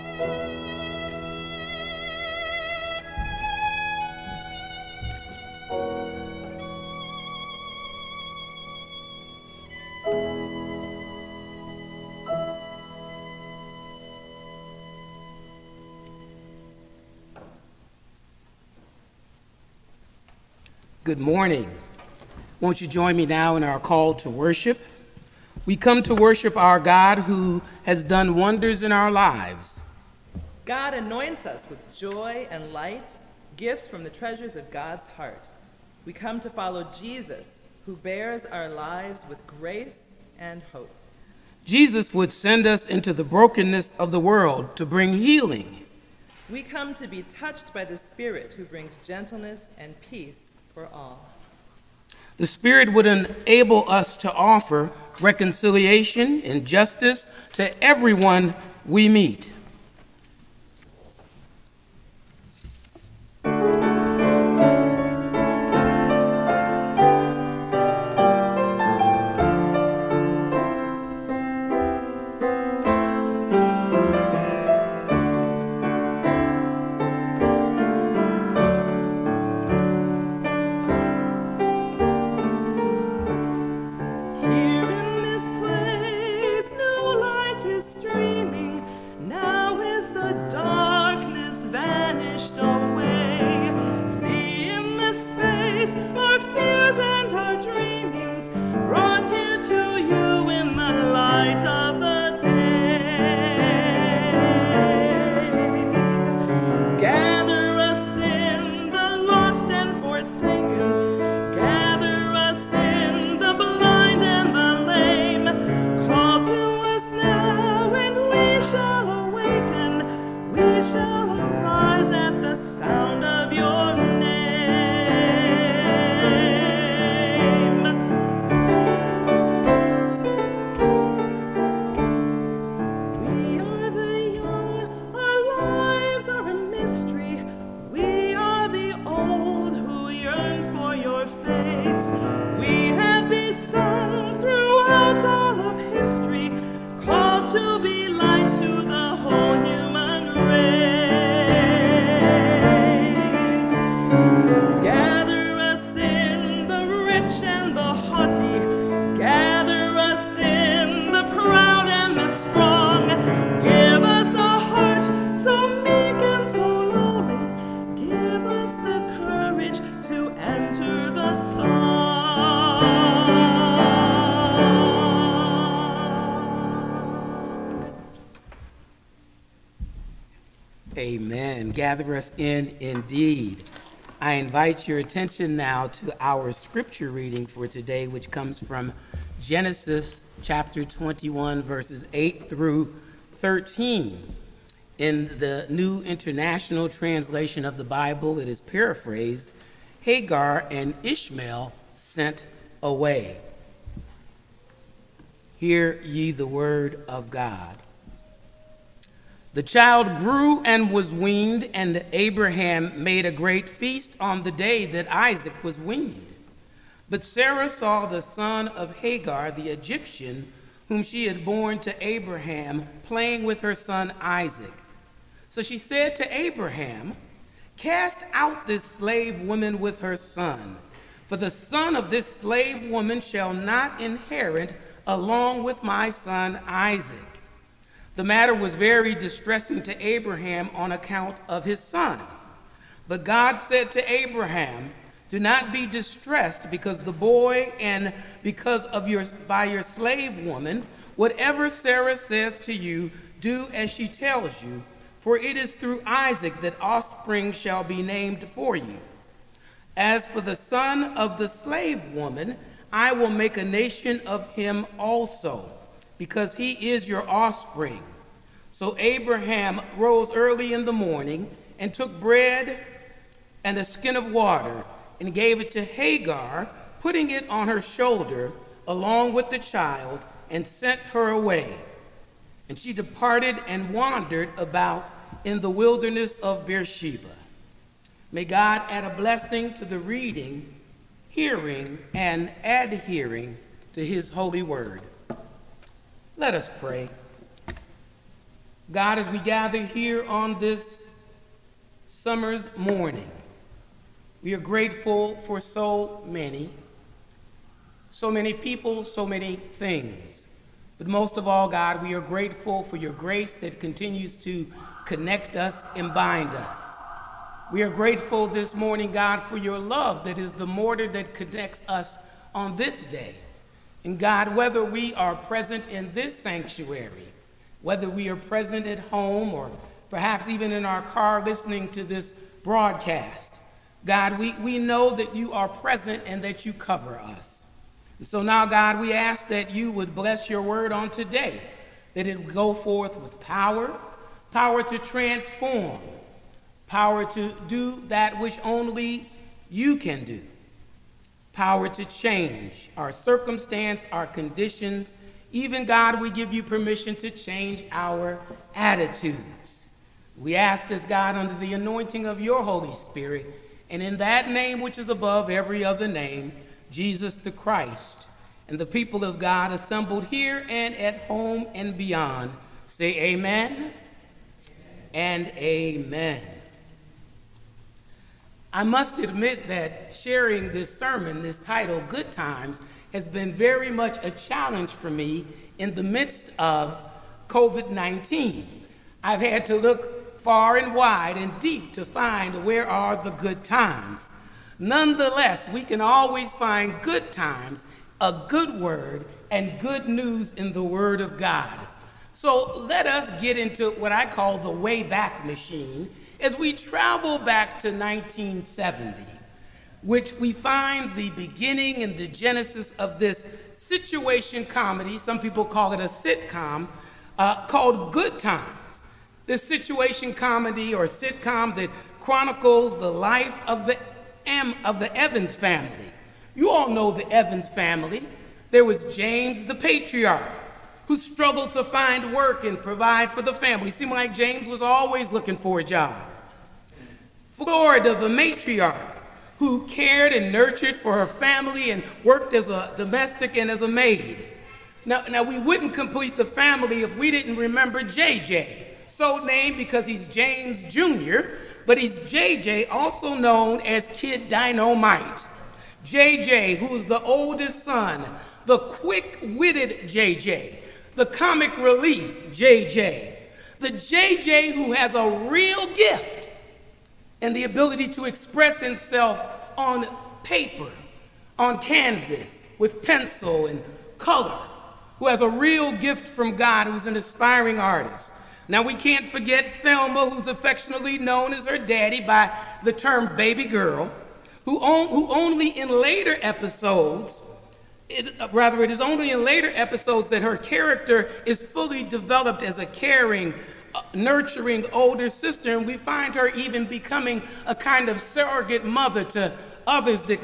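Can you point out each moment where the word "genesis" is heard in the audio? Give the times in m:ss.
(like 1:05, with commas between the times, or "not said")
3:09, 6:52.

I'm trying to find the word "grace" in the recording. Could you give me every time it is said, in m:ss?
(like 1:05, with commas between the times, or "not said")
0:39, 5:13.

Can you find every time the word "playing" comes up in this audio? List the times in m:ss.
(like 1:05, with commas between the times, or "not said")
3:43.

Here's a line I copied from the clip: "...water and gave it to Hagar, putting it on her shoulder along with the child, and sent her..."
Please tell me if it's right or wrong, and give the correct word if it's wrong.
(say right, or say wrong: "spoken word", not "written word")
right.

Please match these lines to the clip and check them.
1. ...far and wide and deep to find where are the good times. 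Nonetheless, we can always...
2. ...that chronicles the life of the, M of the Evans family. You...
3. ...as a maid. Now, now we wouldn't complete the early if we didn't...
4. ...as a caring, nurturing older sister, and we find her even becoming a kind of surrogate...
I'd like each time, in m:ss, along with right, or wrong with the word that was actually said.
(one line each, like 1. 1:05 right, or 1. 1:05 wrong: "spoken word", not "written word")
1. 6:30 right
2. 7:01 right
3. 7:23 wrong: "family", not "early"
4. 8:12 right.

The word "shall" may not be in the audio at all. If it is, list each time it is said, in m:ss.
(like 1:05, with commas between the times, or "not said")
3:53, 4:17.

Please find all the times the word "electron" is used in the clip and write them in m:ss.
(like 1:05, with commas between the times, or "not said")
not said.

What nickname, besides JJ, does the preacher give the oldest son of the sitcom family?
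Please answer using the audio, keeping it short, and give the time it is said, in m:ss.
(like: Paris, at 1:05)
Kid Dynamite, at 7:34.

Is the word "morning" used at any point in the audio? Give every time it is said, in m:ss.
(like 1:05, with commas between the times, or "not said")
0:21, 4:30, 5:02, 5:18.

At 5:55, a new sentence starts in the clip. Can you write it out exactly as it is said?
Even God, we give you permission to change our attitudes.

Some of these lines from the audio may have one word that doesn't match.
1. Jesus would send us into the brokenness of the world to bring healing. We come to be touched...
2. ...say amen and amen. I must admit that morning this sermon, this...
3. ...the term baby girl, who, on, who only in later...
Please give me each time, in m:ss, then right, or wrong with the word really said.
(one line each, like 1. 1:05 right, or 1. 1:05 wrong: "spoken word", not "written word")
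1. 0:41 right
2. 6:12 wrong: "sharing", not "morning"
3. 8:02 right.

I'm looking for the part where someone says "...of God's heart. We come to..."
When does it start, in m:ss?
0:34.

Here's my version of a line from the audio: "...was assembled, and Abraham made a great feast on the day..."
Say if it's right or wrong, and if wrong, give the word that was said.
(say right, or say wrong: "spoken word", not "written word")
wrong: "weaned", not "assembled".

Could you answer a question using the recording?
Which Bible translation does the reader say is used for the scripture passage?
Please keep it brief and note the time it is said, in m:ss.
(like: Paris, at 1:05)
New International Translation, at 3:15.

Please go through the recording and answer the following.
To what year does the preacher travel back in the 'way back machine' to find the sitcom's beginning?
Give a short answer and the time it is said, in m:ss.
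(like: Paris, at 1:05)
1970, at 6:47.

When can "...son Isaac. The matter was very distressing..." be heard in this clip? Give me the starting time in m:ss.
3:56.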